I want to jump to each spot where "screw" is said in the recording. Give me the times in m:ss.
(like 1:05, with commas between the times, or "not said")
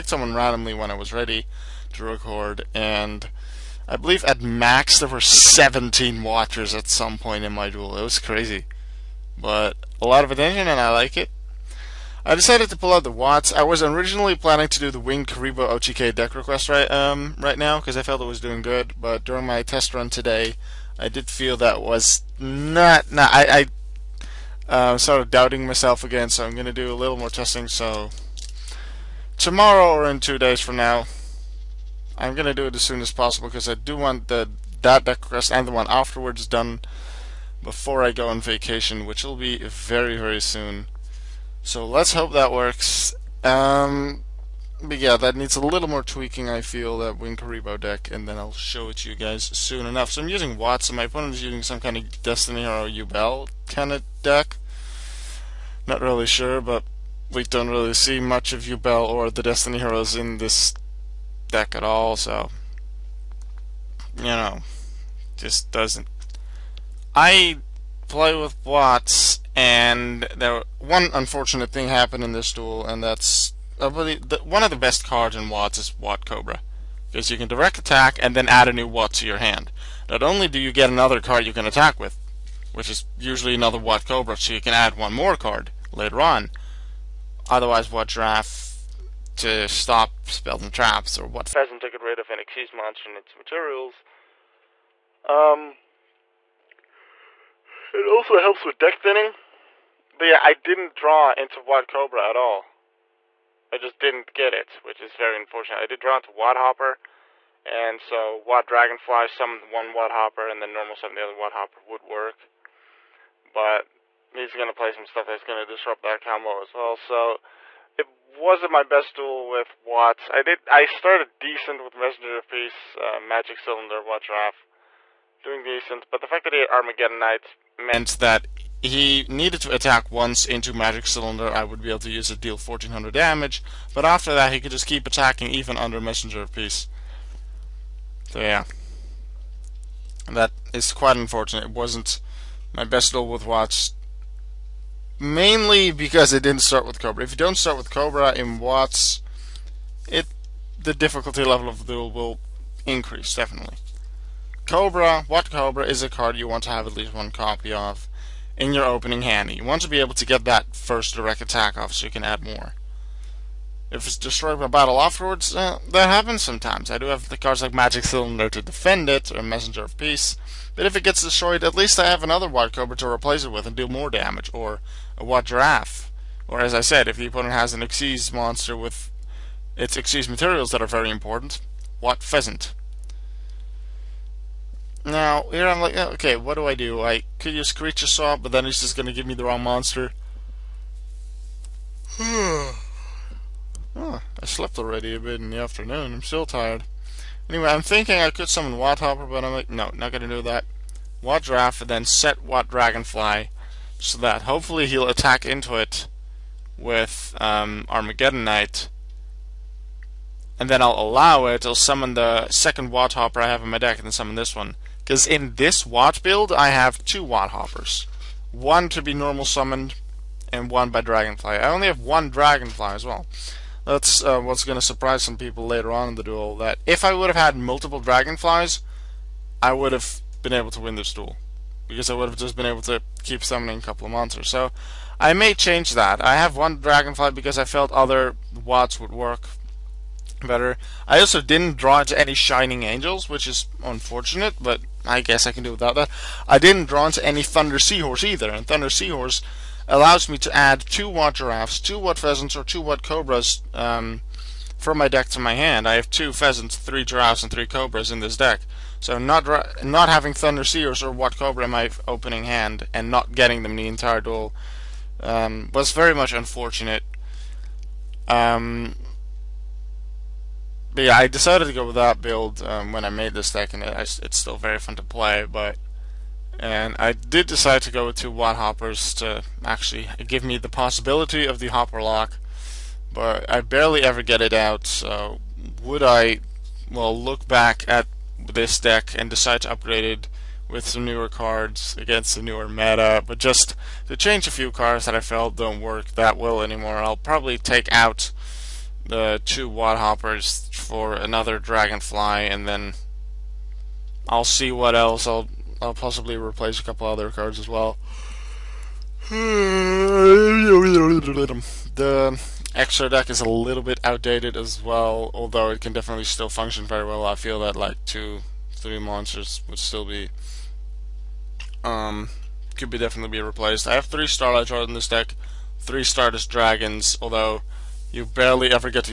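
not said.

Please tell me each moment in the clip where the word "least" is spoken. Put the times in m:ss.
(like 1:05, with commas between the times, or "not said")
2:36, 2:51.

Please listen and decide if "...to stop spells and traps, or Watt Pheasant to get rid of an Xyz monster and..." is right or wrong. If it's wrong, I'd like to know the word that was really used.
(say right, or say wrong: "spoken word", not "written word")
right.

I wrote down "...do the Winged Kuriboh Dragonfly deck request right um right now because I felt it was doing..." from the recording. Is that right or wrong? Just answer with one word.
wrong.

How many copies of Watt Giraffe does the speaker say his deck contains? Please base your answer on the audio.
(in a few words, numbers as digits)
3.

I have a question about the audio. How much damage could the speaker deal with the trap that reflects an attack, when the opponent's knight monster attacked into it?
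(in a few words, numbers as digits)
1400.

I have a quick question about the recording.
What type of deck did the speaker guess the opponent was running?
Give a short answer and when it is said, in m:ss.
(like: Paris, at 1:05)
Destiny Hero Ubel, at 0:52.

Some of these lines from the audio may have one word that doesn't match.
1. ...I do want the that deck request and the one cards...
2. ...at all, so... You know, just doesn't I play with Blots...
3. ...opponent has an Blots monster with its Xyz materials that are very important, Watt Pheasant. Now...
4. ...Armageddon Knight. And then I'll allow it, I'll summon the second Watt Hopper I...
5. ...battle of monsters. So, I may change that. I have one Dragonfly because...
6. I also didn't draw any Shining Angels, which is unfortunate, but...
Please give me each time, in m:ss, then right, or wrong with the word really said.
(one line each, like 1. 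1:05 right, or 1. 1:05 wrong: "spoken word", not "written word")
1. 0:33 wrong: "afterwards", not "cards"
2. 1:01 right
3. 2:57 wrong: "Xyz", not "Blots"
4. 3:27 right
5. 3:53 wrong: "couple", not "battle"
6. 4:01 right.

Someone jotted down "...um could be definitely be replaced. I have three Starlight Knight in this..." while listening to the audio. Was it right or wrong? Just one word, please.
wrong.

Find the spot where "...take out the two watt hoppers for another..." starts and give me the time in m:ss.
4:57.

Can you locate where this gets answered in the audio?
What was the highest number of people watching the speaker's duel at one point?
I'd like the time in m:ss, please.
0:05.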